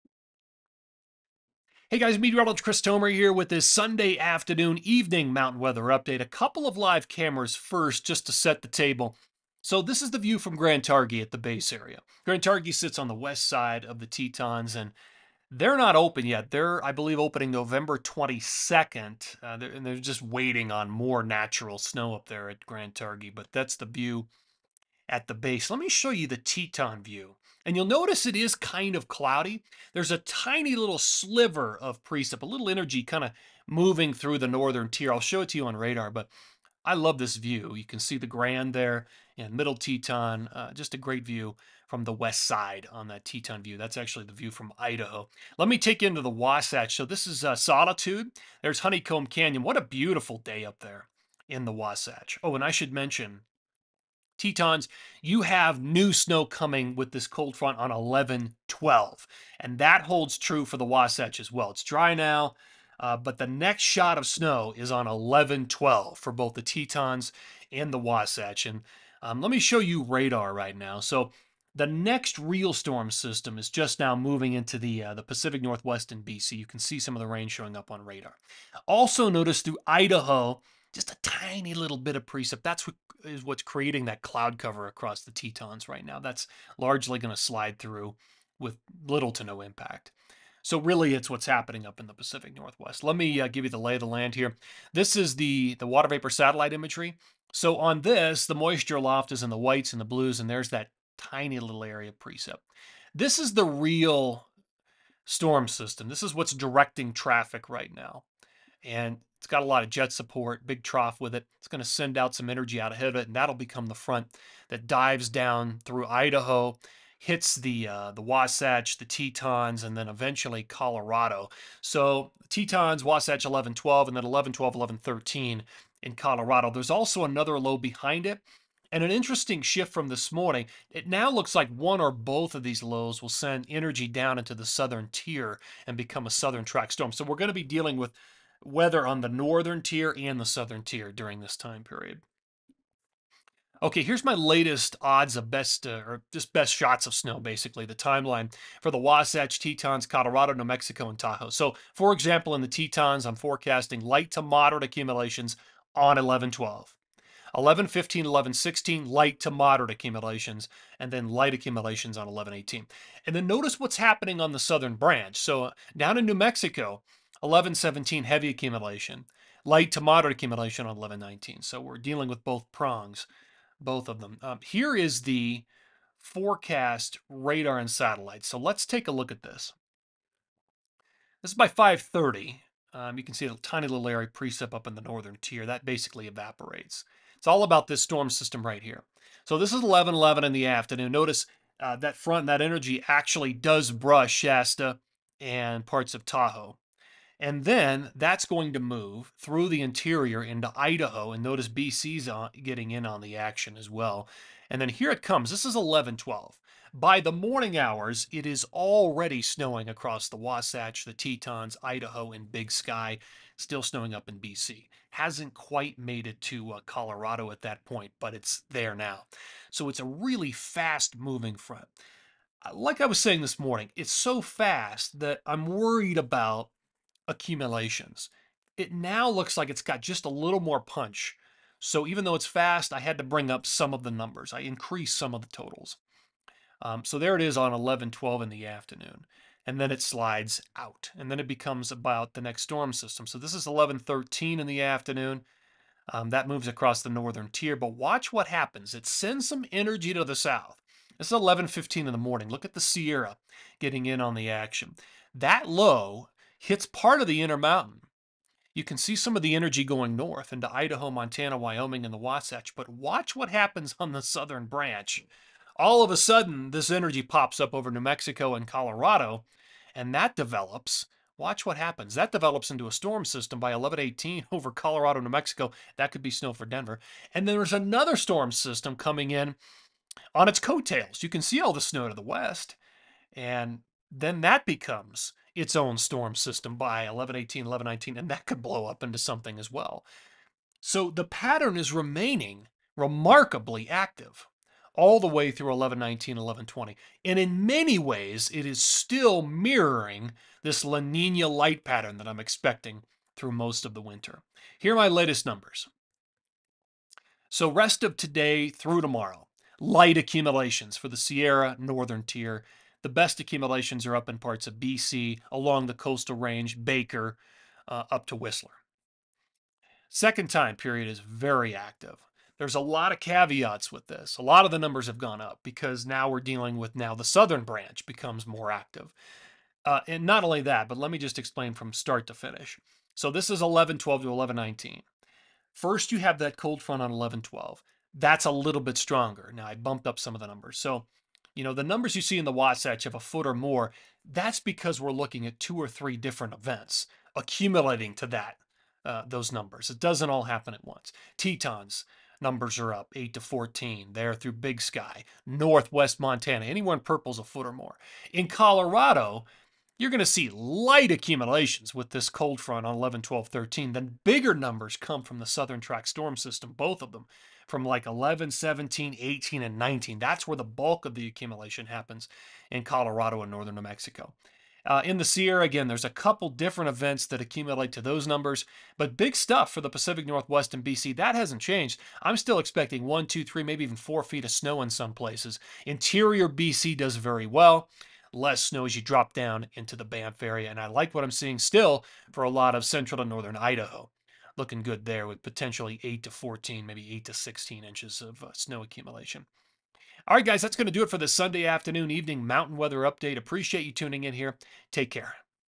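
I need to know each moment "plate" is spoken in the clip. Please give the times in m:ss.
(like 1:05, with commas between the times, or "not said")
not said.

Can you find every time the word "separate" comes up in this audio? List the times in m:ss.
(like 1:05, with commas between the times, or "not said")
not said.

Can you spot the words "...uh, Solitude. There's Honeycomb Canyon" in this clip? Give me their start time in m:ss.
0:47.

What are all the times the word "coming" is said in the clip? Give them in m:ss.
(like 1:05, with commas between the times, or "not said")
0:56, 4:38.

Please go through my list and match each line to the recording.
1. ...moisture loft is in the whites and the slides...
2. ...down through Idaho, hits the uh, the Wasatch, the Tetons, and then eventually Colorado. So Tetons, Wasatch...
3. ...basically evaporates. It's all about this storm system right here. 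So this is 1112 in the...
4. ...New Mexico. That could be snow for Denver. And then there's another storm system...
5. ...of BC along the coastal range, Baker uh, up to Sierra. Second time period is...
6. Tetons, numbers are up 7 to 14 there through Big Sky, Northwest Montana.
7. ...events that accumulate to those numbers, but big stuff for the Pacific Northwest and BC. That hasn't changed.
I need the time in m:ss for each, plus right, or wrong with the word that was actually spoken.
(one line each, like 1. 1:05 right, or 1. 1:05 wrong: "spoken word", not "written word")
1. 1:38 wrong: "blues", not "slides"
2. 1:55 right
3. 3:05 wrong: "1111", not "1112"
4. 4:35 right
5. 5:14 wrong: "Whistler", not "Sierra"
6. 5:51 wrong: "8", not "7"
7. 6:16 right.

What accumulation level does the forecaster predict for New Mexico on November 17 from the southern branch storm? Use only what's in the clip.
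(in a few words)
heavy accumulation.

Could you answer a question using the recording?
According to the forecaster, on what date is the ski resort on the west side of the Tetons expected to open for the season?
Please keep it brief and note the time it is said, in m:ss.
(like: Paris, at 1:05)
November 22nd, at 0:17.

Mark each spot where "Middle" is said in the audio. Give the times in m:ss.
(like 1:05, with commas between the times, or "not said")
0:39.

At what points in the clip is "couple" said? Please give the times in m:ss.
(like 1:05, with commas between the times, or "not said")
0:06, 6:16.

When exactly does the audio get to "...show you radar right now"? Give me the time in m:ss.
1:09.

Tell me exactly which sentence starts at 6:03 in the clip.
Then bigger numbers come from the southern track storm system, both of them from like 11, 17, 18, and 19.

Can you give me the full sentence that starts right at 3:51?
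So even though it's fast, I had to bring up some of the numbers.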